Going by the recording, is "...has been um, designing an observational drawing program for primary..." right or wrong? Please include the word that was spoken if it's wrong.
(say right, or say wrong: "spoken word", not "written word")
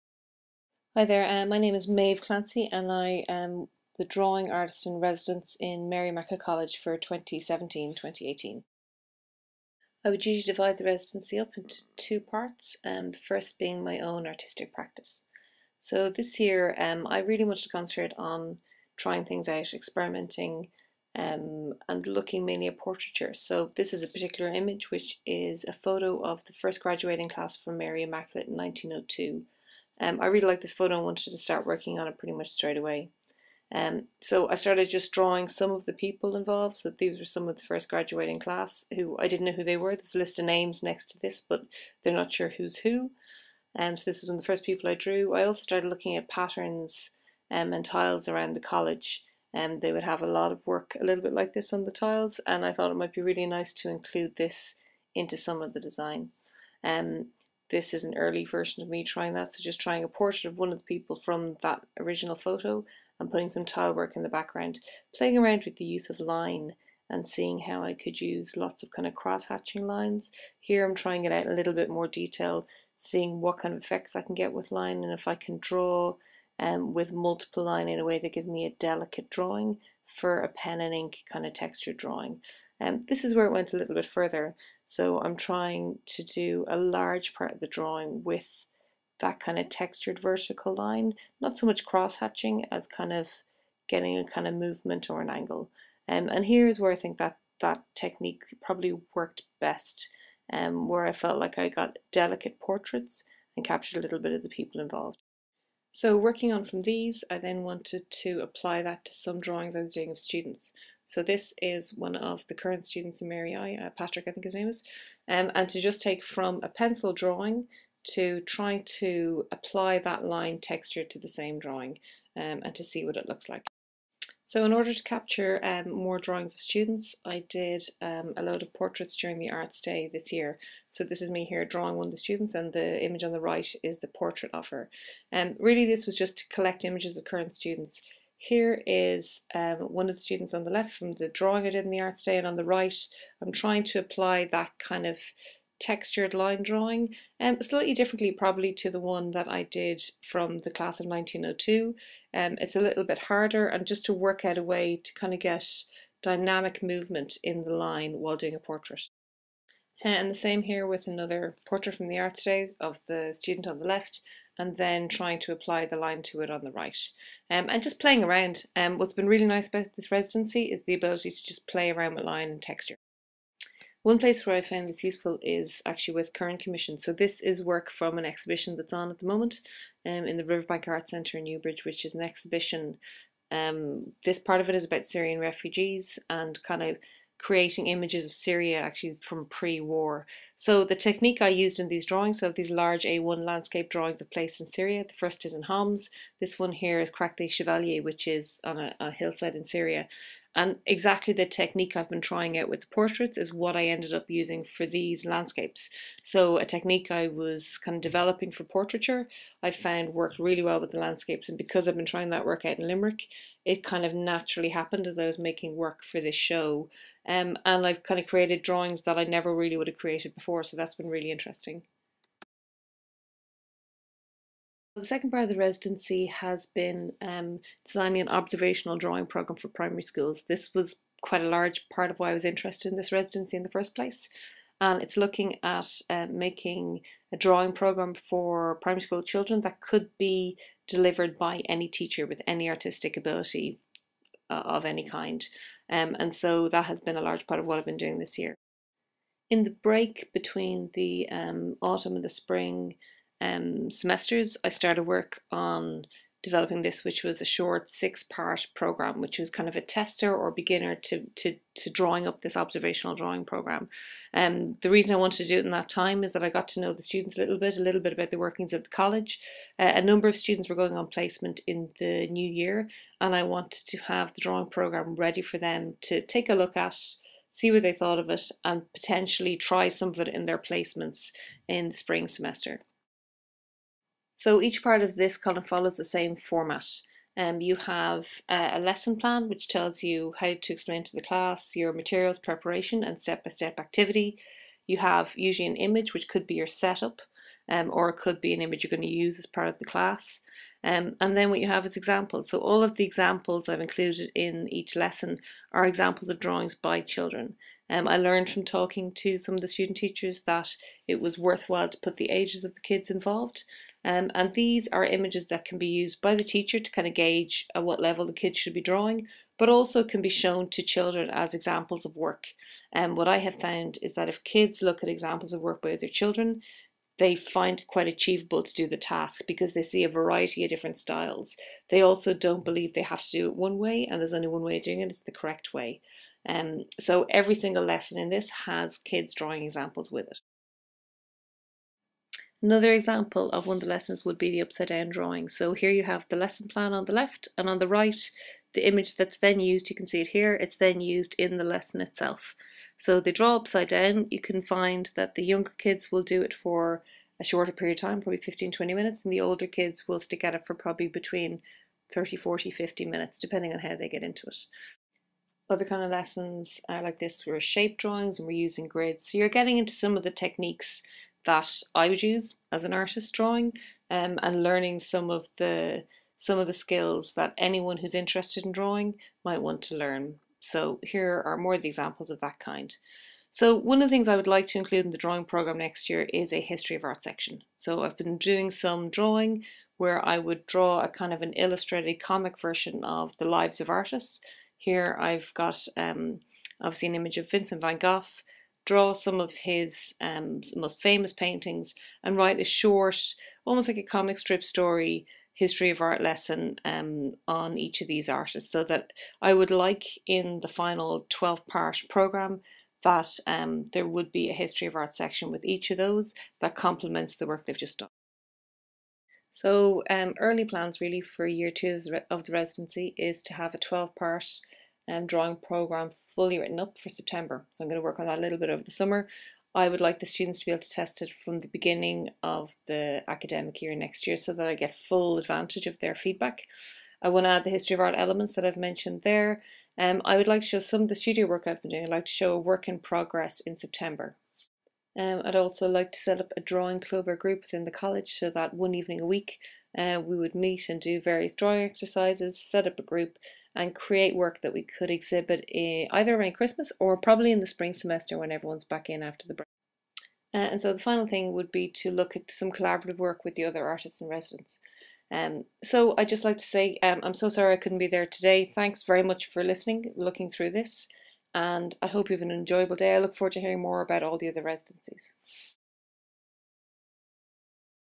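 right.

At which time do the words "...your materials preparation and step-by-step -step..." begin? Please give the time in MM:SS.
04:51.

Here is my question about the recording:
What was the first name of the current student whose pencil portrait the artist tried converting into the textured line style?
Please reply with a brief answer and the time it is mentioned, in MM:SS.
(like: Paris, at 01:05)
Patrick, at 01:53.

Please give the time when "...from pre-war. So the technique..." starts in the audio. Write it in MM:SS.
03:09.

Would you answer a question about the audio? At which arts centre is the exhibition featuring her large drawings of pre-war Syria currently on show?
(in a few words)
Riverbank Art Centre.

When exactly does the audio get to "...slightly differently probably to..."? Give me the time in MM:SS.
02:27.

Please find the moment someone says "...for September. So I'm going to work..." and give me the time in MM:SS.
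07:06.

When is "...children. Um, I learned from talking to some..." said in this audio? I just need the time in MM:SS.
05:07.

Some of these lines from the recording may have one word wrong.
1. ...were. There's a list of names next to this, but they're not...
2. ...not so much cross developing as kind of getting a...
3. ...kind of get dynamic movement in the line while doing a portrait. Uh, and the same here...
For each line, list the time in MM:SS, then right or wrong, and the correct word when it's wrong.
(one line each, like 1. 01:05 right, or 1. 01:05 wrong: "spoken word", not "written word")
1. 00:39 right
2. 01:31 wrong: "hatching", not "developing"
3. 02:35 right.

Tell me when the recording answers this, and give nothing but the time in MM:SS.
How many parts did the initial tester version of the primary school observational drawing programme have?
04:17.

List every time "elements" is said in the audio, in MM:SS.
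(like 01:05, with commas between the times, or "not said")
07:18.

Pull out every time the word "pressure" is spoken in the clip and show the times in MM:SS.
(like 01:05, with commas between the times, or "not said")
not said.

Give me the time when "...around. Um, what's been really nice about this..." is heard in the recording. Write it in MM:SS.
02:48.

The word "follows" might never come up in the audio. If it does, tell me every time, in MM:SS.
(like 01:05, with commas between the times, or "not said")
04:45.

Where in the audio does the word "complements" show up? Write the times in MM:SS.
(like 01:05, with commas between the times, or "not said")
06:56.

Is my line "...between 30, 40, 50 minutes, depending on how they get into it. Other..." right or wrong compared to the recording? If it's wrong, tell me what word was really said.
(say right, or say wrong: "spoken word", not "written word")
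right.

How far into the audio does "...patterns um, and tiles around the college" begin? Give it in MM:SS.
00:46.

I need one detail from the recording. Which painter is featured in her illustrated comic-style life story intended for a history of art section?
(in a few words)
Vincent van Gogh.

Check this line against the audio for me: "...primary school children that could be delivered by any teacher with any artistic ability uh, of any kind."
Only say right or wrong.
right.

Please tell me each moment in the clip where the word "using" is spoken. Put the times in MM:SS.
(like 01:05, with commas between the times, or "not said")
03:24, 06:08.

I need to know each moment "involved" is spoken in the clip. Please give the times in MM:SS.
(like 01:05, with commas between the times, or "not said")
00:36, 01:44, 05:13.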